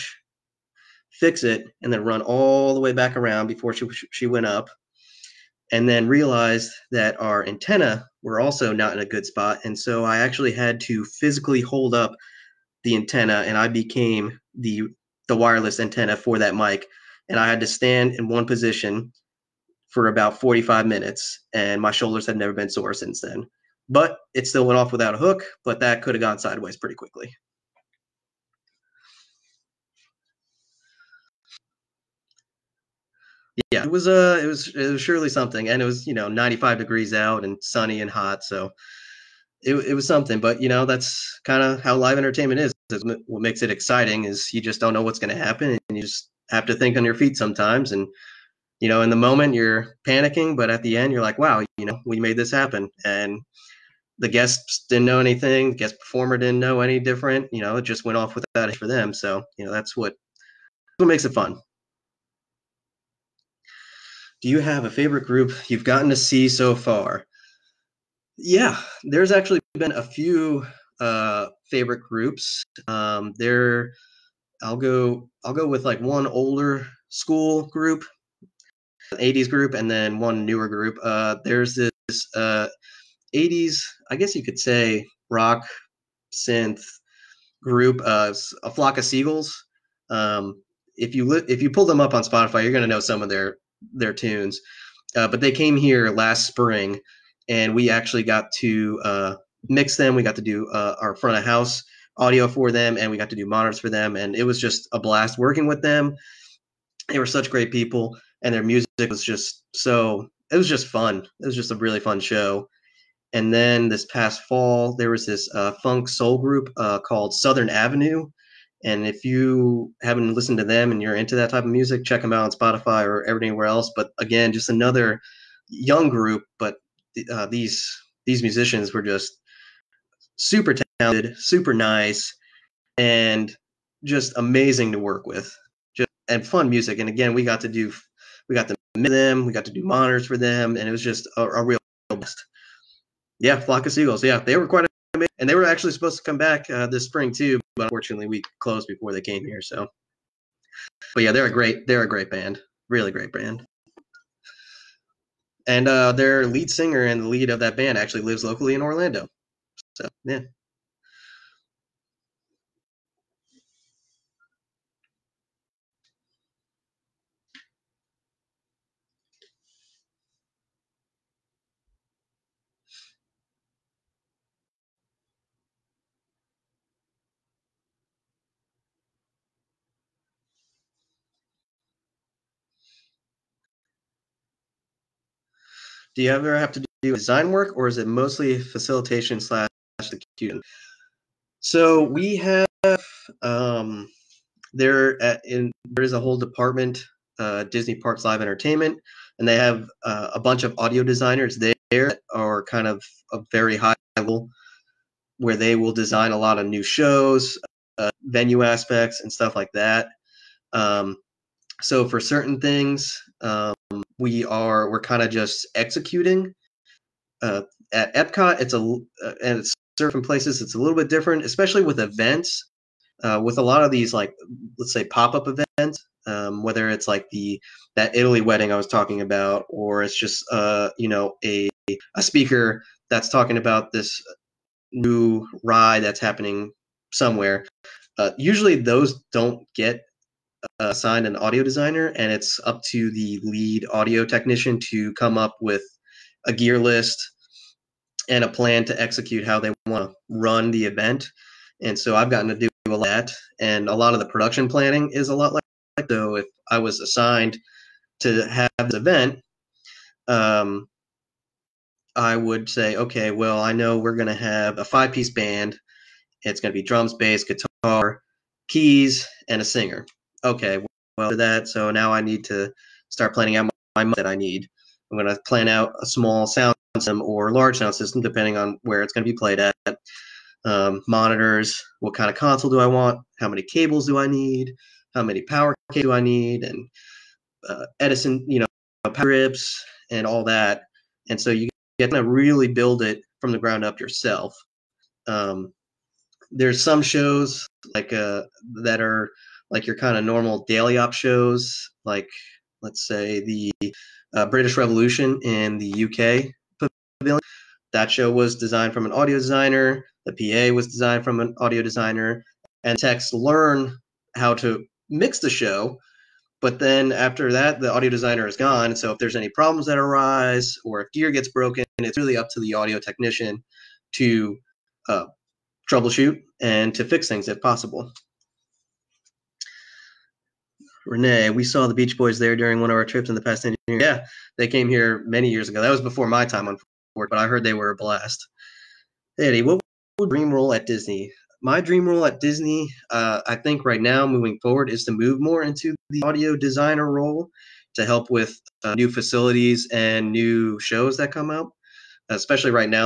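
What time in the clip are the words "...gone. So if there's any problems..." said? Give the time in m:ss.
5:18.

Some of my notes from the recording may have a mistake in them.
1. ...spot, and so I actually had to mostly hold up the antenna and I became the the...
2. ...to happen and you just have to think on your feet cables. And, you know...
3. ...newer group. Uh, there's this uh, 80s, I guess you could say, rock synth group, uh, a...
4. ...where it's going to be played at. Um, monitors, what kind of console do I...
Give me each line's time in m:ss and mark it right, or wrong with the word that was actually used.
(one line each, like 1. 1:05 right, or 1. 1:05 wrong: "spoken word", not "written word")
1. 0:09 wrong: "physically", not "mostly"
2. 0:45 wrong: "sometimes", not "cables"
3. 1:20 right
4. 4:38 right.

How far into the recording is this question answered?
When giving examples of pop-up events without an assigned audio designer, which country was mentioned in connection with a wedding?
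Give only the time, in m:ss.
3:48.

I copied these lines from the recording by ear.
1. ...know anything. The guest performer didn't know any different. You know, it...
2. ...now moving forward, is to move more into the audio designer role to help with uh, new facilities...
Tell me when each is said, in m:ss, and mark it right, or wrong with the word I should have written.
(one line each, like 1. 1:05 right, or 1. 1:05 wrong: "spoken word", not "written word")
1. 0:55 right
2. 5:43 right.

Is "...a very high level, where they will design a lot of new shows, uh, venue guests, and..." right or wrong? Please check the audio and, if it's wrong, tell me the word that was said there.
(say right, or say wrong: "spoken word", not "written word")
wrong: "aspects", not "guests".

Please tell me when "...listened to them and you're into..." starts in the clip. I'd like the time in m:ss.
2:00.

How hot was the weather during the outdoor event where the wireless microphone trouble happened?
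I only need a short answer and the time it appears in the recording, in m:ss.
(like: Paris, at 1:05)
95 degrees, at 0:36.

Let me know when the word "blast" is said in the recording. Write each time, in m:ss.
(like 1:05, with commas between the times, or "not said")
1:44, 2:22, 5:37.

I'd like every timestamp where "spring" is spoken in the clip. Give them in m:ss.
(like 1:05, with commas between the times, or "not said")
1:36, 2:27.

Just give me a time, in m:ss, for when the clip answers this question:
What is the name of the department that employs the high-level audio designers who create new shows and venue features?
3:17.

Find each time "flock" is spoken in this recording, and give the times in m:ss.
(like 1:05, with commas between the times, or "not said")
1:28, 2:23.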